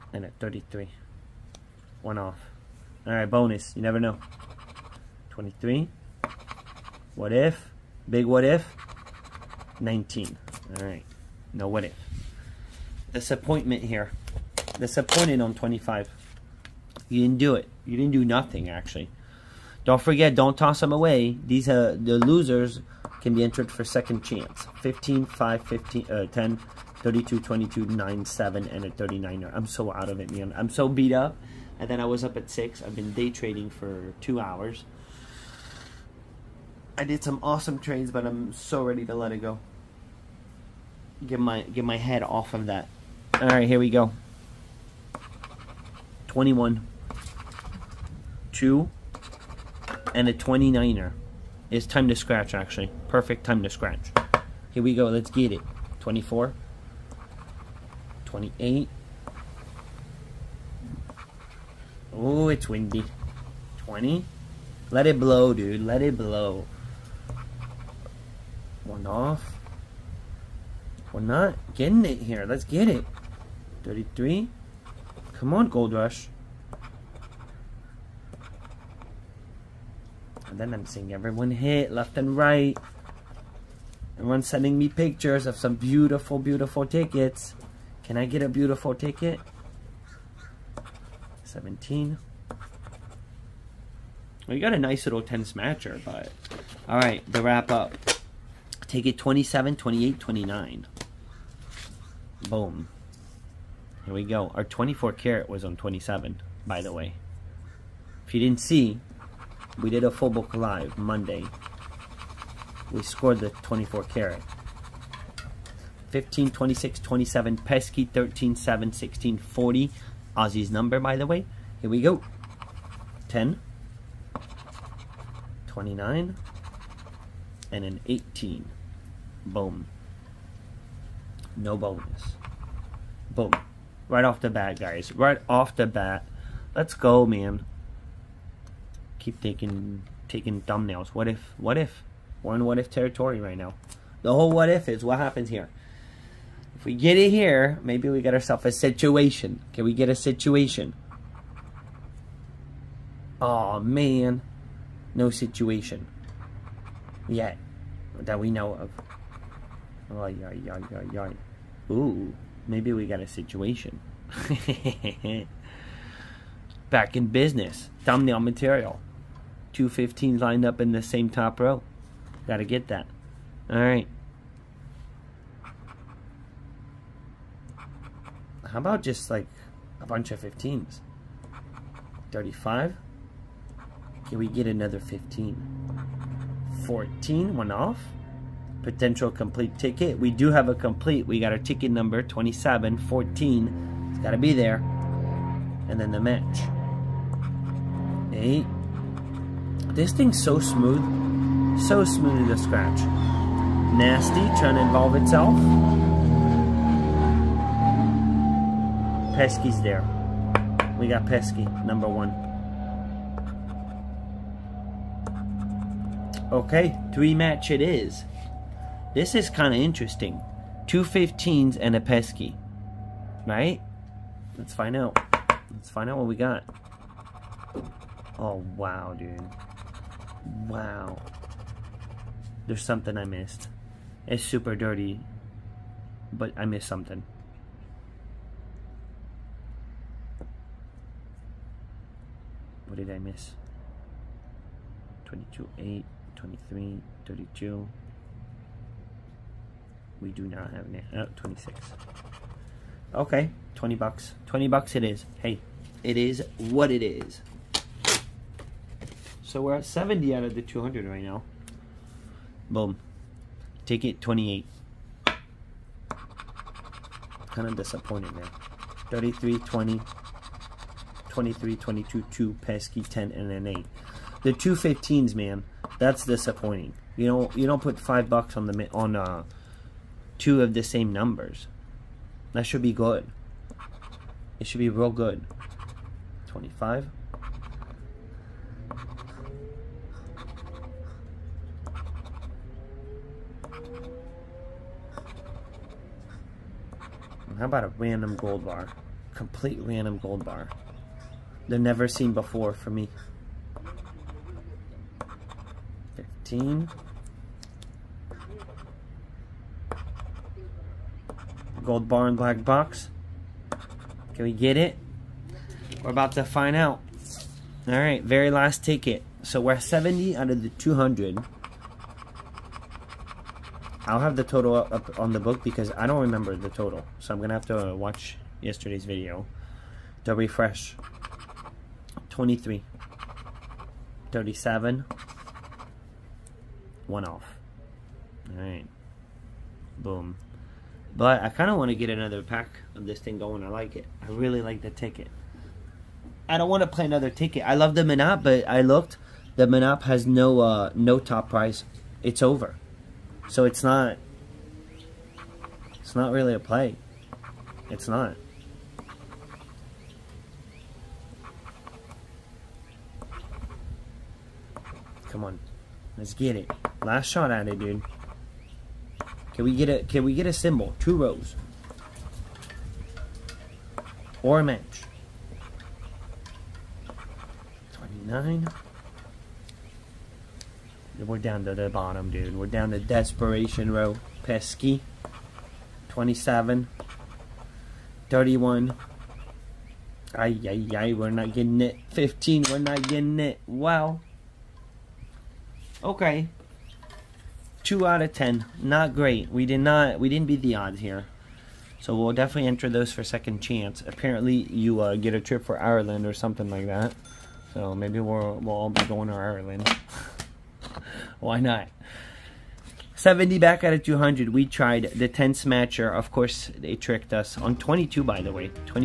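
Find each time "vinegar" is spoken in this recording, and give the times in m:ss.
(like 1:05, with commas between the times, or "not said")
not said.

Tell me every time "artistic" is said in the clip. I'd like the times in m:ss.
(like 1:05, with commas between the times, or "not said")
not said.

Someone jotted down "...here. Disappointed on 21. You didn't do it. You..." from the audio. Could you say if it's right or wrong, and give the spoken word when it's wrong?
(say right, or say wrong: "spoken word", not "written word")
wrong: "25", not "21".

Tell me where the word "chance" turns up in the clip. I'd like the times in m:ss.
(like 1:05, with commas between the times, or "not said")
0:24, 6:43.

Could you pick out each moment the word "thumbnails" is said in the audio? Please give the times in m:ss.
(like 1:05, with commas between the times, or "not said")
2:20, 2:48.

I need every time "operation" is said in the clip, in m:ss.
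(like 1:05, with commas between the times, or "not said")
not said.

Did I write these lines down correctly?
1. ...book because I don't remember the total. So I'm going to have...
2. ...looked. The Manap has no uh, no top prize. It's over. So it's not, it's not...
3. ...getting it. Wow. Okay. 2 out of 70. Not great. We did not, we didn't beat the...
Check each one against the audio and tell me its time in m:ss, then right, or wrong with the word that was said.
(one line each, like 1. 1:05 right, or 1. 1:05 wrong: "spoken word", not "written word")
1. 5:25 right
2. 5:48 right
3. 6:33 wrong: "10", not "70".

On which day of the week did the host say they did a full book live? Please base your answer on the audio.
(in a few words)
Monday.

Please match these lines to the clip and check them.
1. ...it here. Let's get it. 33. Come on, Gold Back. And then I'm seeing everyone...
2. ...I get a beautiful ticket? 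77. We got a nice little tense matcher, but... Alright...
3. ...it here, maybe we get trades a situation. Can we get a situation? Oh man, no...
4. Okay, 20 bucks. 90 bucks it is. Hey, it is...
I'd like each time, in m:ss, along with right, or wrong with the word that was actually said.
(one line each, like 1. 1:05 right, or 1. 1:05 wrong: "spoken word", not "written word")
1. 1:12 wrong: "Rush", not "Back"
2. 1:28 wrong: "17", not "77"
3. 2:27 wrong: "ourselves", not "trades"
4. 4:13 wrong: "20", not "90".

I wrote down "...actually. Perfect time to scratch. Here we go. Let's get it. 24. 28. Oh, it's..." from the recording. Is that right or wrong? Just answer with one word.
right.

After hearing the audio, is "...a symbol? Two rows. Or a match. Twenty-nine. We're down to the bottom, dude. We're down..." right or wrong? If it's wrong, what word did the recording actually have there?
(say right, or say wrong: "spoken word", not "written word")
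right.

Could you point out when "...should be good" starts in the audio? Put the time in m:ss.
4:42.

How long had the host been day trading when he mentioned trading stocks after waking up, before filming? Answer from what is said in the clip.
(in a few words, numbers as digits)
2 hours.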